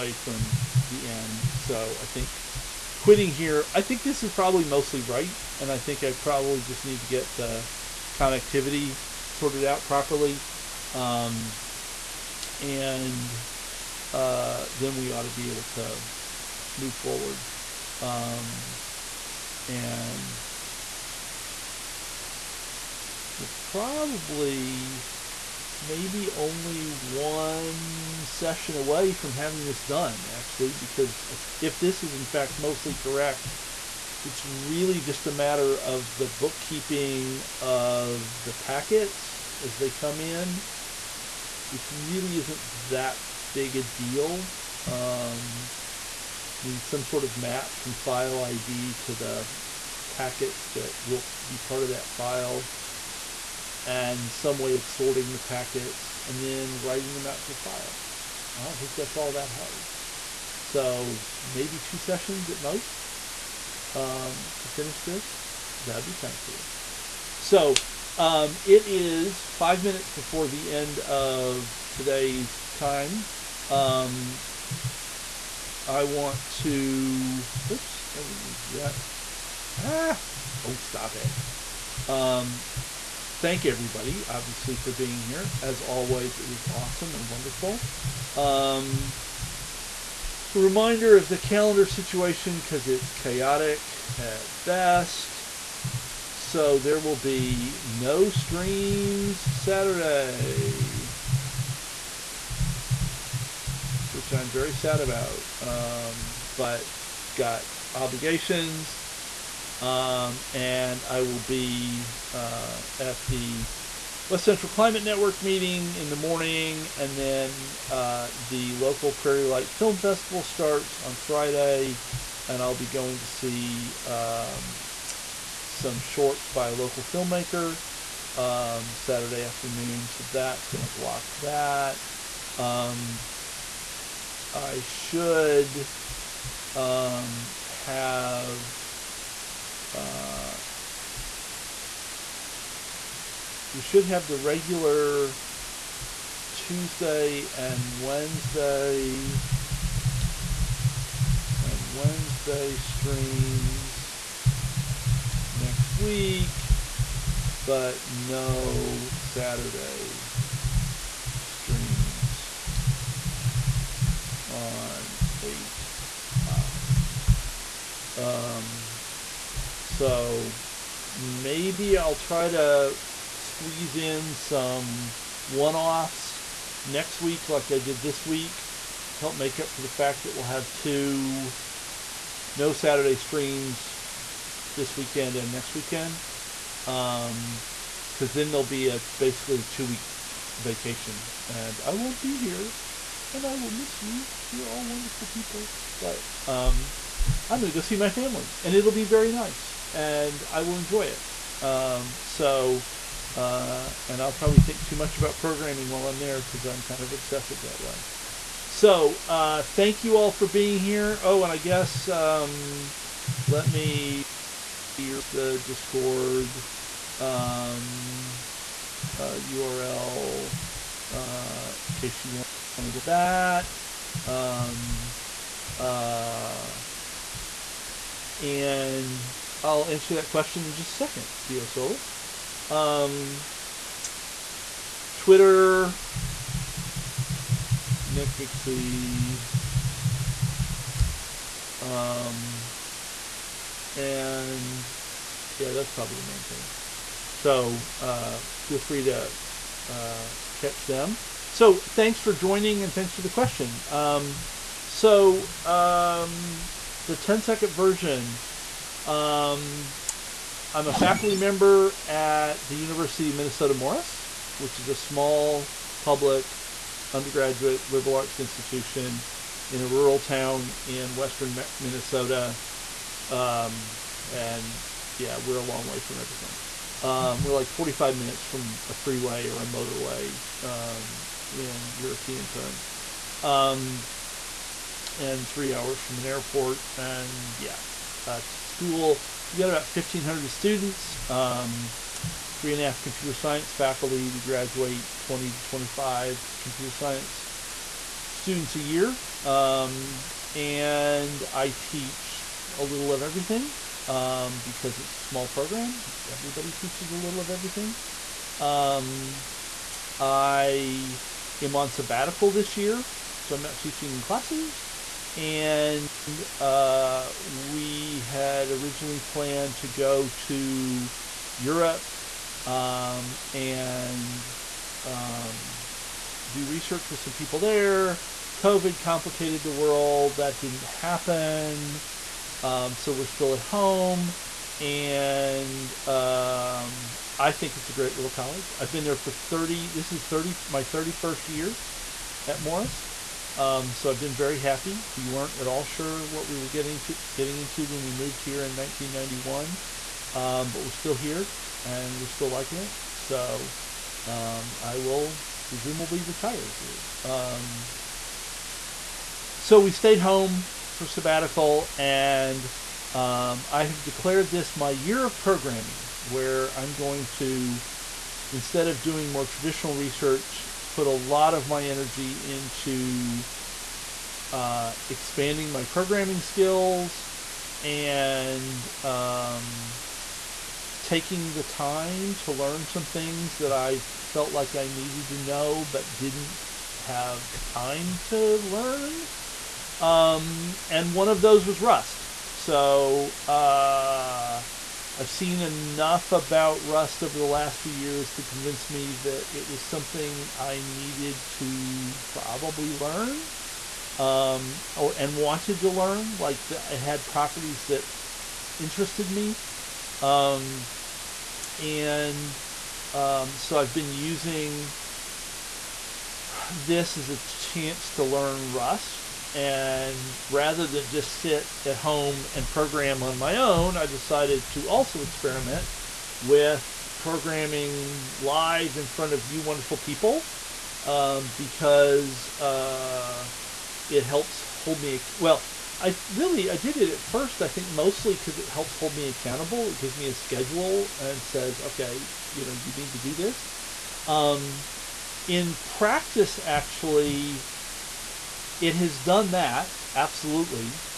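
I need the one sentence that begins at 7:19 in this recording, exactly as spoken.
It gives me a schedule and says, okay, you know, you need to do this.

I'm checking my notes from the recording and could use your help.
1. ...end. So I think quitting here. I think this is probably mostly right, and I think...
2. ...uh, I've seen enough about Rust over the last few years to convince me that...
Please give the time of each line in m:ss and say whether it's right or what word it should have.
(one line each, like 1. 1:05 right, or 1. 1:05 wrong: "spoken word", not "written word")
1. 0:01 right
2. 6:33 right.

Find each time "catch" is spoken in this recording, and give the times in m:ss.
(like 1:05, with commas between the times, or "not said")
4:10.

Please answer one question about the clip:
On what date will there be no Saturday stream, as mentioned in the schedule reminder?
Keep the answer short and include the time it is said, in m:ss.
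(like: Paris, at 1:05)
8 Oct, at 2:45.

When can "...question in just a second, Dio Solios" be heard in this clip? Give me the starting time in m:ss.
3:50.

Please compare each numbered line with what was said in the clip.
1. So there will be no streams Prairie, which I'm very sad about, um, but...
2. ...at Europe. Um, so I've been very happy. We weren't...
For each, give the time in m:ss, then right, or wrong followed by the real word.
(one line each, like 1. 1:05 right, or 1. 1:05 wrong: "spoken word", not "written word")
1. 1:36 wrong: "Saturday", not "Prairie"
2. 5:42 wrong: "Morris", not "Europe".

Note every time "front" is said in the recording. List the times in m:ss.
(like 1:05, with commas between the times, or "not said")
7:09.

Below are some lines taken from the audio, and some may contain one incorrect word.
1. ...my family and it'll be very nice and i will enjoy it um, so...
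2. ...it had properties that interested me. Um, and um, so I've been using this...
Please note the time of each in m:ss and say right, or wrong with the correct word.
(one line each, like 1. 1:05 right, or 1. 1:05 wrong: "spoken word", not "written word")
1. 3:17 right
2. 6:46 right.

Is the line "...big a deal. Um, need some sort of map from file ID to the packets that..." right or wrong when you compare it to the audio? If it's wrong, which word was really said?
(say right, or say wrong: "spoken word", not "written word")
right.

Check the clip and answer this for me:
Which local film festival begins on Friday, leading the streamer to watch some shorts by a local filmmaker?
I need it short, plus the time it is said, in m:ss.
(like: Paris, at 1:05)
Prairie Light Film Festival, at 1:59.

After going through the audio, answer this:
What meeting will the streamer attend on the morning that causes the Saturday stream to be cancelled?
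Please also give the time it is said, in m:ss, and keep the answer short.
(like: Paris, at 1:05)
West Central Climate Network, at 1:54.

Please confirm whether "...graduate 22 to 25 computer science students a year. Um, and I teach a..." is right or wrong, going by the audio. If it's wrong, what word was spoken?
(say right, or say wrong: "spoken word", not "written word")
wrong: "20", not "22".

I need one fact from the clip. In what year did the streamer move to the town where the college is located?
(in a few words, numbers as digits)
1991.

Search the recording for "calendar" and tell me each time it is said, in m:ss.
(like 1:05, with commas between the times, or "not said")
1:31.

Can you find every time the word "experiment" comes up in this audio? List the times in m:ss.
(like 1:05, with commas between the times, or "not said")
7:05.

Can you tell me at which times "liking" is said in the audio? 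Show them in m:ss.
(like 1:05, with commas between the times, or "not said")
5:52.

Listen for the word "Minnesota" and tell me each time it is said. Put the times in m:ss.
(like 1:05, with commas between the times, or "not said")
4:23, 4:31.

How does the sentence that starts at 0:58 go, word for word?
I don't think that's all that hard.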